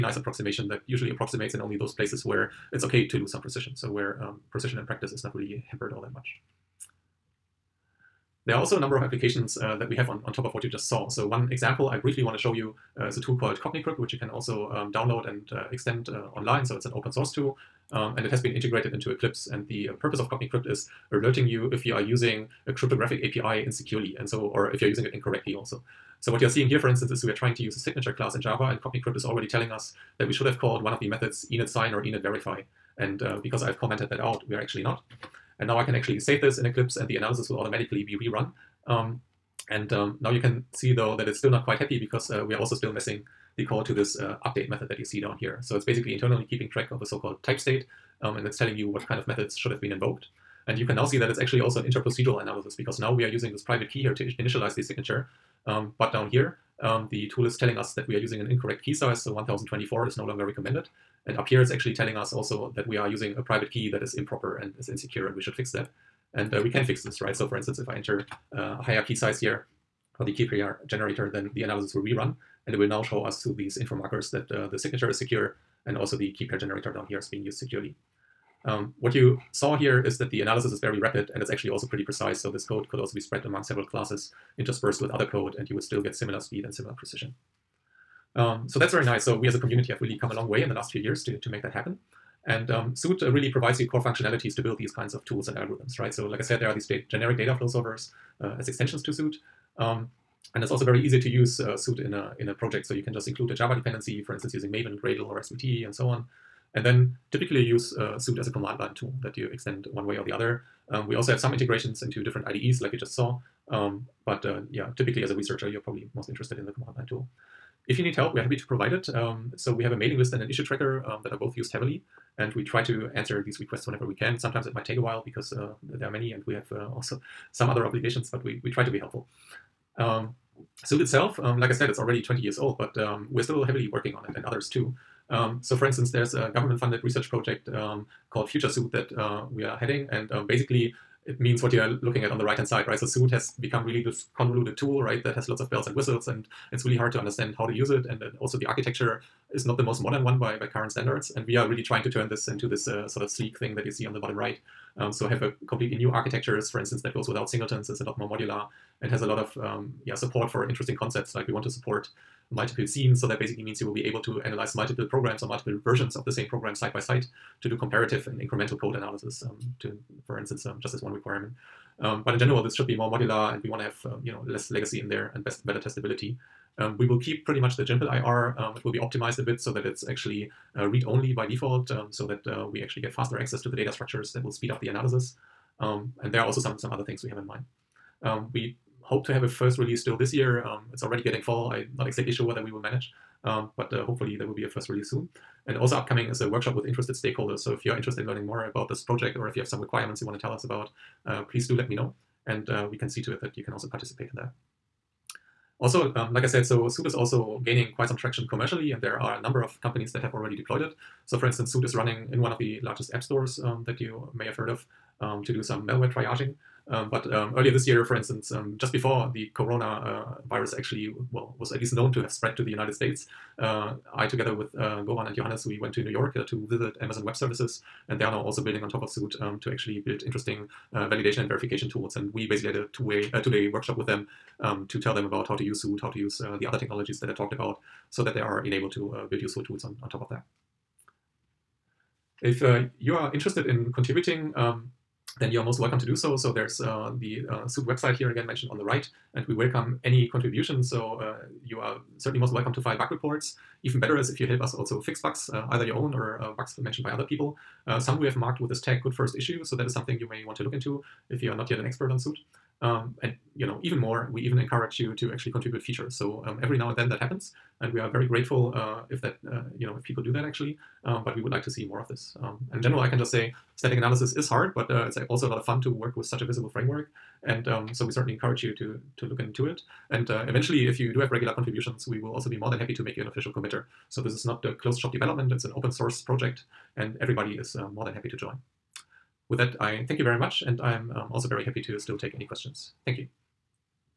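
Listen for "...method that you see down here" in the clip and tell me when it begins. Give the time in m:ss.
0:44.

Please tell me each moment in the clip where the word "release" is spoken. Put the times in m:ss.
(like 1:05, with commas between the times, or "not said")
3:09, 3:14.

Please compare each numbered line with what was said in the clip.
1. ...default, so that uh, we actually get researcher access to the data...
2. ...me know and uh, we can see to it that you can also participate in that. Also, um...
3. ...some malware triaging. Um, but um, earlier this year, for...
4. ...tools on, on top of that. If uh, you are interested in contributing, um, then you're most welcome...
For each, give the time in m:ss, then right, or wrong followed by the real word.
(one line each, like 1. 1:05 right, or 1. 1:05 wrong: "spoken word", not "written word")
1. 3:01 wrong: "faster", not "researcher"
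2. 3:21 right
3. 3:35 right
4. 3:59 right.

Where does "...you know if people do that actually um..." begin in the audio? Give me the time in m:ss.
4:29.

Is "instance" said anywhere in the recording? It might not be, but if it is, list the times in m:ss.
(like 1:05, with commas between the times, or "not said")
0:26, 1:07, 1:44, 2:15, 2:36, 2:50, 3:31, 3:38.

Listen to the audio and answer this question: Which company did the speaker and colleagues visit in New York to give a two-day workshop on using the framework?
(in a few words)
Amazon Web Services.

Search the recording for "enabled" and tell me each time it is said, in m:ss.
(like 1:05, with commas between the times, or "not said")
3:58.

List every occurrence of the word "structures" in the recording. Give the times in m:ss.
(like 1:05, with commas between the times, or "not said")
3:03.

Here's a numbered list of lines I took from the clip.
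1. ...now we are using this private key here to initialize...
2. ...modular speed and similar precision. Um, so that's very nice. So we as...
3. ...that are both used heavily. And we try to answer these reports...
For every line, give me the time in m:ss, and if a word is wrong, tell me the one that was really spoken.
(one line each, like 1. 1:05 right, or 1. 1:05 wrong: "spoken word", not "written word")
1. 0:52 right
2. 1:26 wrong: "similar", not "modular"
3. 2:01 wrong: "requests", not "reports".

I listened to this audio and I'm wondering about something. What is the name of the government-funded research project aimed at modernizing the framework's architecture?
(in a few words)
Future Soot.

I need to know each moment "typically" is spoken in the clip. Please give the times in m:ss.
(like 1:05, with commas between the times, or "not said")
1:47, 1:54.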